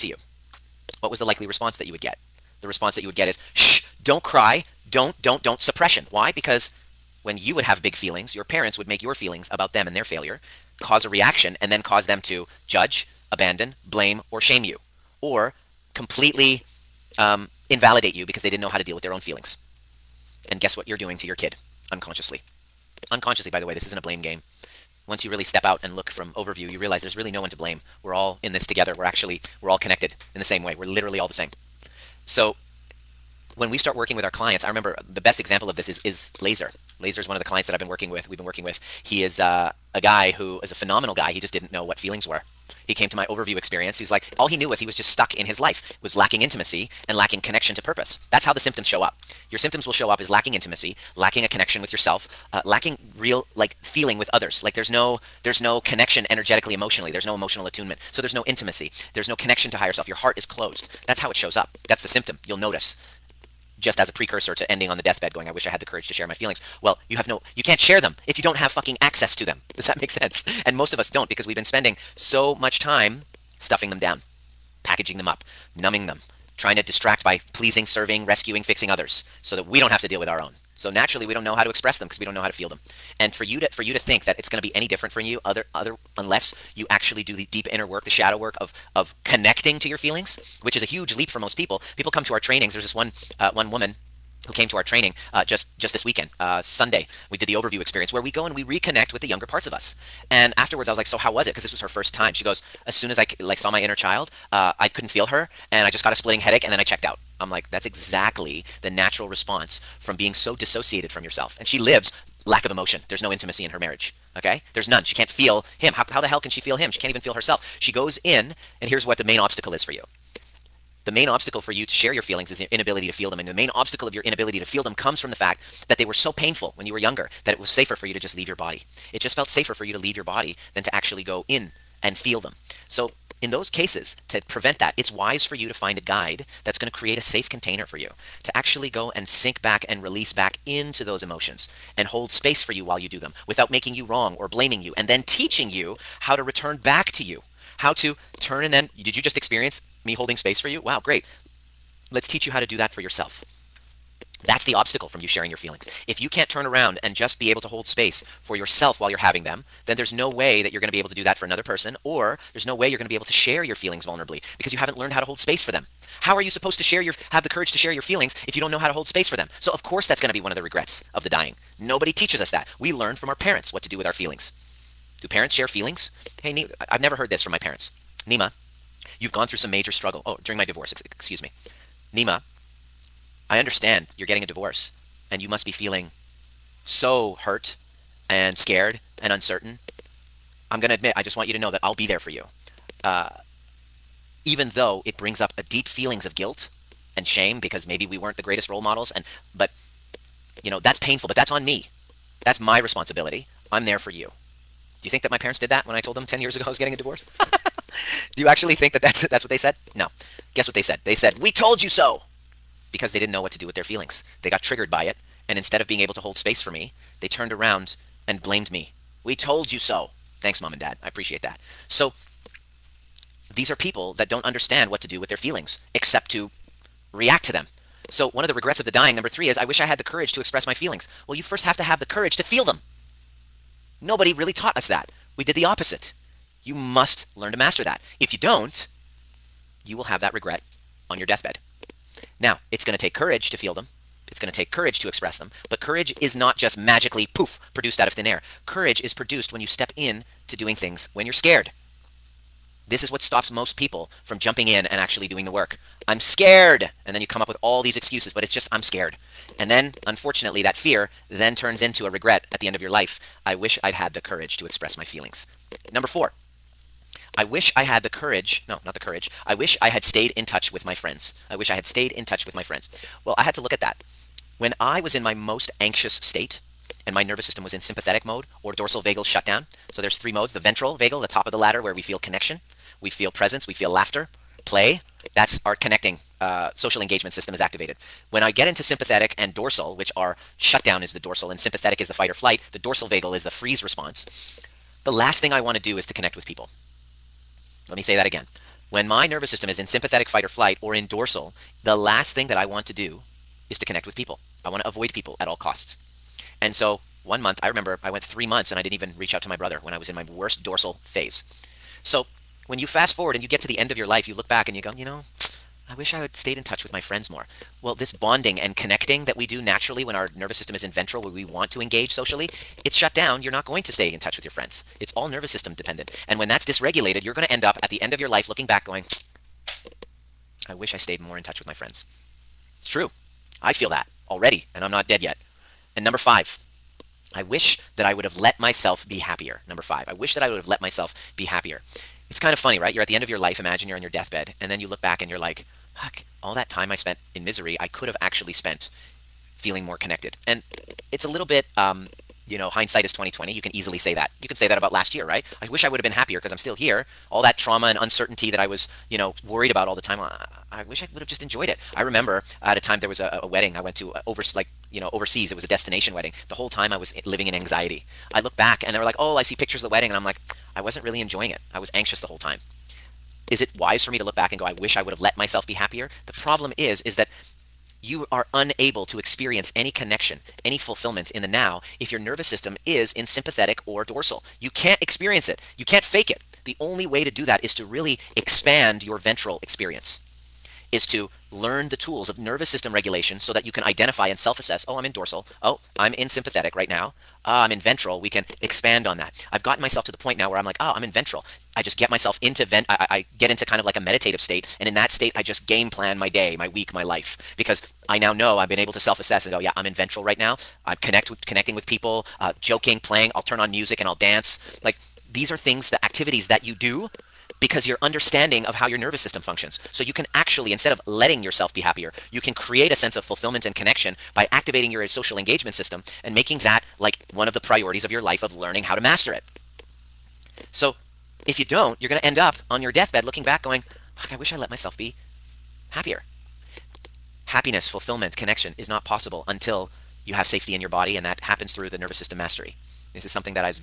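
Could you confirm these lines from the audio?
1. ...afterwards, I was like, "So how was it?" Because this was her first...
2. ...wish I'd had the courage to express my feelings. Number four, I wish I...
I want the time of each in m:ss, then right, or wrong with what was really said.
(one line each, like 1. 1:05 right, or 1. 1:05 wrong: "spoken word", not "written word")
1. 1:40 right
2. 4:23 right.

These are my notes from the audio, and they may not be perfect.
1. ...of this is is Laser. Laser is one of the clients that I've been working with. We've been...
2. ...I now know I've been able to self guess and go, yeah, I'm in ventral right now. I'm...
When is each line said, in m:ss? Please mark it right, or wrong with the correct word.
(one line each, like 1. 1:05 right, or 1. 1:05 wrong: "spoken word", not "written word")
1. 0:35 right
2. 6:48 wrong: "assess", not "guess".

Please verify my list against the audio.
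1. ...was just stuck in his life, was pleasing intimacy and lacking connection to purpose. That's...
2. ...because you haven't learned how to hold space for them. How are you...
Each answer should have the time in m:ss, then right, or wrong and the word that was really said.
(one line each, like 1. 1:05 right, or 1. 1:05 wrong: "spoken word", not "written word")
1. 0:44 wrong: "lacking", not "pleasing"
2. 2:44 right.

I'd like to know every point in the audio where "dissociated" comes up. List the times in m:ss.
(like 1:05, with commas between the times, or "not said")
1:50.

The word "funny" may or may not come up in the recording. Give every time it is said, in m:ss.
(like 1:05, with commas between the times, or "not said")
5:42.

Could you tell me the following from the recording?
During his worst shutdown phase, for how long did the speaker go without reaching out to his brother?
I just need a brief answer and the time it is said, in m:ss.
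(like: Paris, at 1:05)
three months, at 5:08.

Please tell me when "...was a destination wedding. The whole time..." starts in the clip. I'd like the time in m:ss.
6:05.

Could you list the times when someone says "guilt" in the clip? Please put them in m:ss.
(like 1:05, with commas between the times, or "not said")
3:16.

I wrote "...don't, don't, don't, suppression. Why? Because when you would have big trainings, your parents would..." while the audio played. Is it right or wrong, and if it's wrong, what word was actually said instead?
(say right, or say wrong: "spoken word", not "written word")
wrong: "feelings", not "trainings".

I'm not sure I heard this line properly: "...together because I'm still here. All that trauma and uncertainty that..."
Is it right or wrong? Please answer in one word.
wrong.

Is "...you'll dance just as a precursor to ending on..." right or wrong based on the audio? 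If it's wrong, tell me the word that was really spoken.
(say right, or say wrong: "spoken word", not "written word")
wrong: "notice", not "dance".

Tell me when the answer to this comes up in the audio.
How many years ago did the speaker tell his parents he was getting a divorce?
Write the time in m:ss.
3:26.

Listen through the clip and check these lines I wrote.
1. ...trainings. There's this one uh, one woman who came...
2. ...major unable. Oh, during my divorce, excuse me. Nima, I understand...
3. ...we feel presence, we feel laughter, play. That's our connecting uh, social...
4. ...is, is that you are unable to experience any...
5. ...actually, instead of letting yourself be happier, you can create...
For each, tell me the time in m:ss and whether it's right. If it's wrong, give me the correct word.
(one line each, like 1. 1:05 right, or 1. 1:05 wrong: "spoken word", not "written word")
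1. 1:32 right
2. 2:59 wrong: "struggle", not "unable"
3. 4:43 right
4. 6:16 right
5. 7:00 right.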